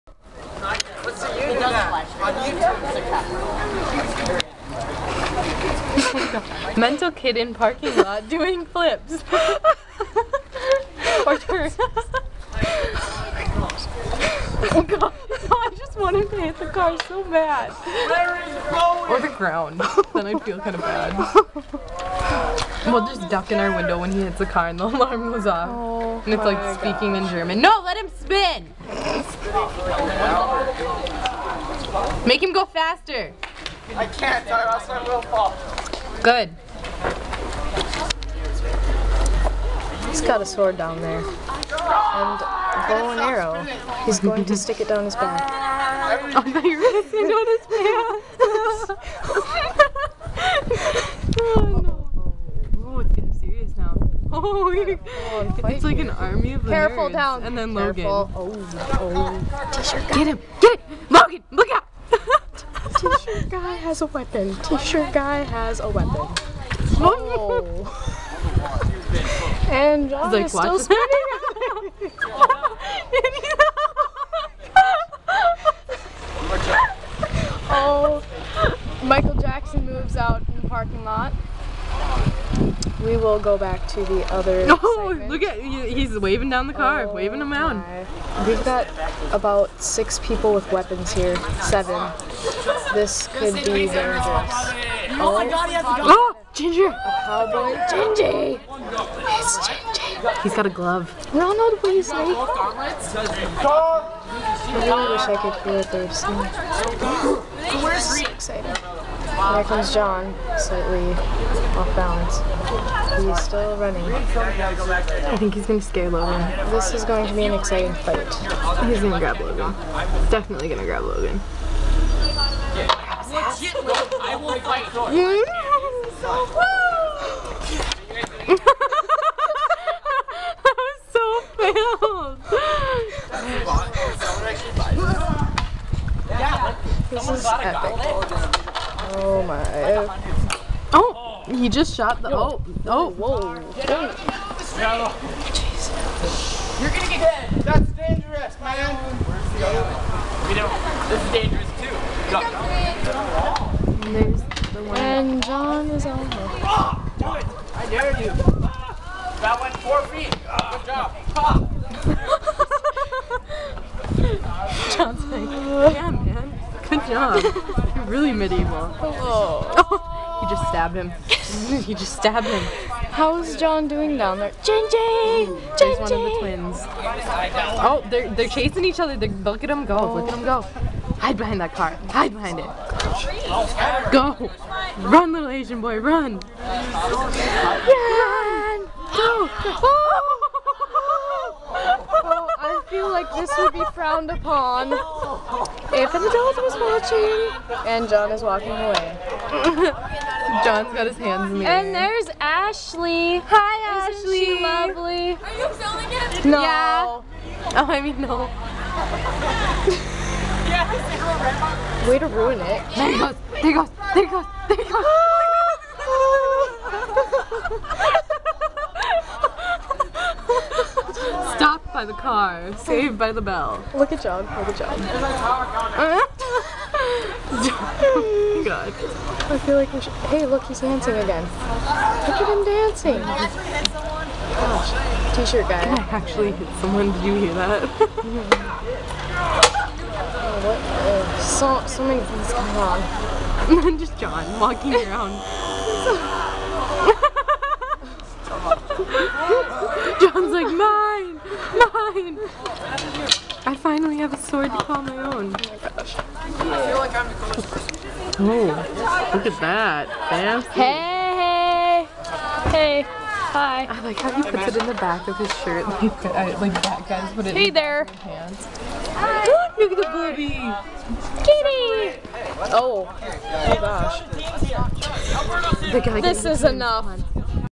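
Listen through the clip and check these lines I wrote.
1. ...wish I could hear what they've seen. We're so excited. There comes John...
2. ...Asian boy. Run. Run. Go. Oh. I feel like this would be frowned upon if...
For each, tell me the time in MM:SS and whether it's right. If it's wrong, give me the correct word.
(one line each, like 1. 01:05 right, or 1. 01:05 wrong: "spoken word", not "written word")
1. 01:45 right
2. 03:05 right.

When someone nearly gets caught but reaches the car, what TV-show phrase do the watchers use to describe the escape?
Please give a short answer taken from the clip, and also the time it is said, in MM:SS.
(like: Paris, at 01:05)
Saved by the bell, at 03:42.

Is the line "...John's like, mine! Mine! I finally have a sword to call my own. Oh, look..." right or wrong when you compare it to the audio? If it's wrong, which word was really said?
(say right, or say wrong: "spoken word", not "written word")
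right.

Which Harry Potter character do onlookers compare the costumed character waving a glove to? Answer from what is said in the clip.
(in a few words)
Ronald Weasley.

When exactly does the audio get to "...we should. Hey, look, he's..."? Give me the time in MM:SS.
03:49.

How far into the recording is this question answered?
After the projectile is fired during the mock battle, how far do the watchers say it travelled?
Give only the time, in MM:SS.
02:39.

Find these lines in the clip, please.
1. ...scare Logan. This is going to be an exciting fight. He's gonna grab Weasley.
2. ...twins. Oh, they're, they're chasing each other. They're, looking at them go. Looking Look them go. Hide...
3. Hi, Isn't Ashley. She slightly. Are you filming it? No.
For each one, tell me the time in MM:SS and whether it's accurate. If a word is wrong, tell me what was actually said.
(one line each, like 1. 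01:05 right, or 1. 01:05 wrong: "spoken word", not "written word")
1. 01:55 wrong: "Logan", not "Weasley"
2. 02:56 right
3. 03:23 wrong: "lovely", not "slightly".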